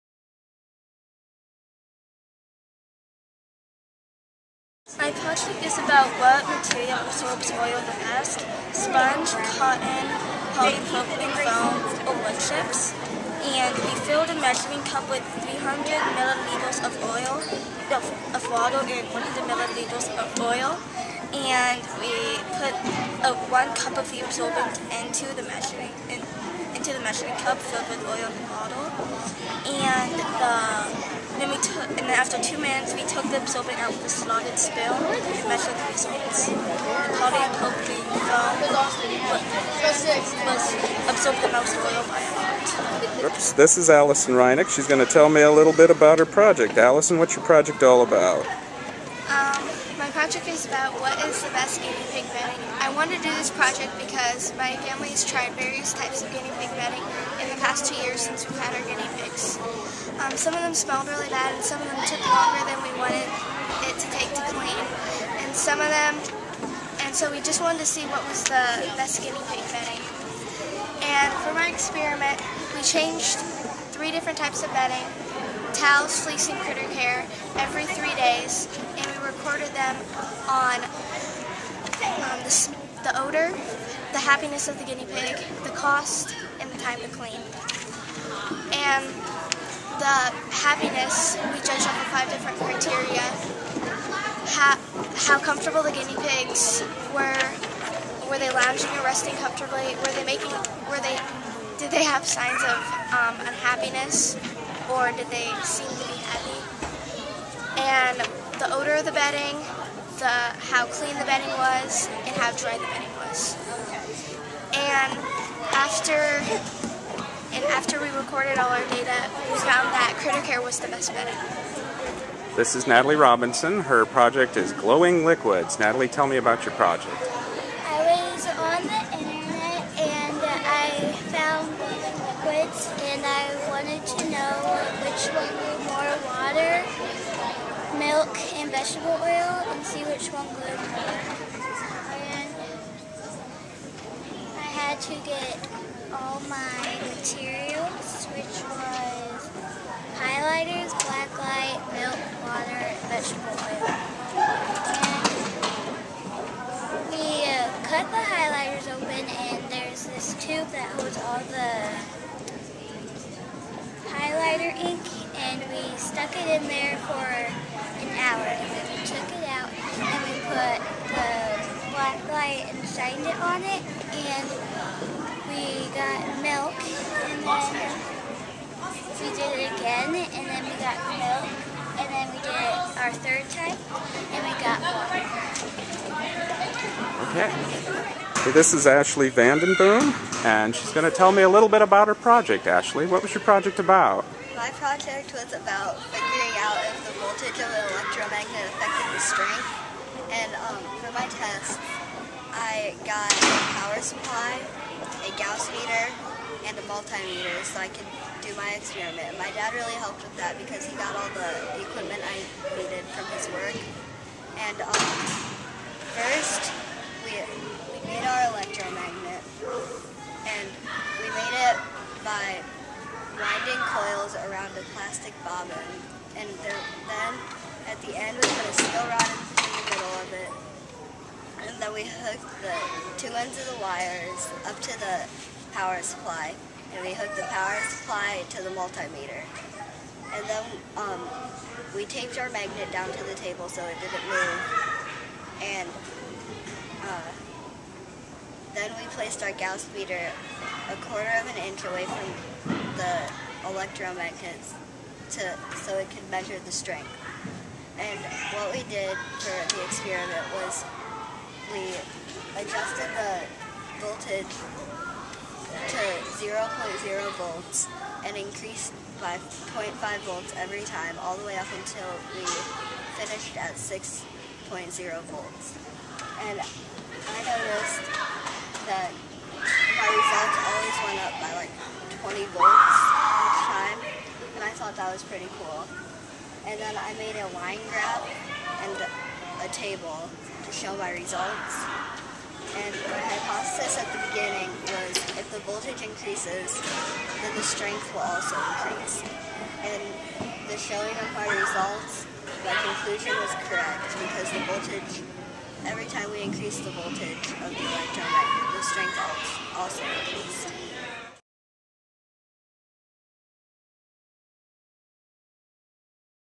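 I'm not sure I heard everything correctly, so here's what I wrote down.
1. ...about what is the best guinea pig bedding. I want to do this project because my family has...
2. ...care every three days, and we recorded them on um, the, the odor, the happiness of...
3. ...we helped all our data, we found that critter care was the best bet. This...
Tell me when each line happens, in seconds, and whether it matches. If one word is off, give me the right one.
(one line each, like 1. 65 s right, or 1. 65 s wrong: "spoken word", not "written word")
1. 50 s right
2. 76 s right
3. 118 s wrong: "recorded", not "helped".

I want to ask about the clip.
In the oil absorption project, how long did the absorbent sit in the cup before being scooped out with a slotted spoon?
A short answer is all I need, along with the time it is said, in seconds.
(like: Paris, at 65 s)
2 minutes, at 32 s.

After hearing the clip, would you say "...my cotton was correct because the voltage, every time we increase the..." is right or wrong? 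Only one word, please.
wrong.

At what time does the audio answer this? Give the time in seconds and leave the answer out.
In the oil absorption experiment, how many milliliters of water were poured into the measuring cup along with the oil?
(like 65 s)
15 s.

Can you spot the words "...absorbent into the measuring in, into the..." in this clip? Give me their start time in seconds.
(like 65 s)
24 s.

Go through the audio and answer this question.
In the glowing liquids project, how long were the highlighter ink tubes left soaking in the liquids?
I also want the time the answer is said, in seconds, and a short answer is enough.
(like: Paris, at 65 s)
1 hour, at 167 s.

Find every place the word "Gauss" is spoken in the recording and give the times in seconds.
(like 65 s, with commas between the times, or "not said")
205 s, 249 s.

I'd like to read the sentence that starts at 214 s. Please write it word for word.
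And um, first, we, we made our electromagnet, and we made it by winding coils around a plastic bobbin.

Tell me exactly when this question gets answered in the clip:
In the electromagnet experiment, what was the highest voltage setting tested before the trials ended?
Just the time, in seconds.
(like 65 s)
273 s.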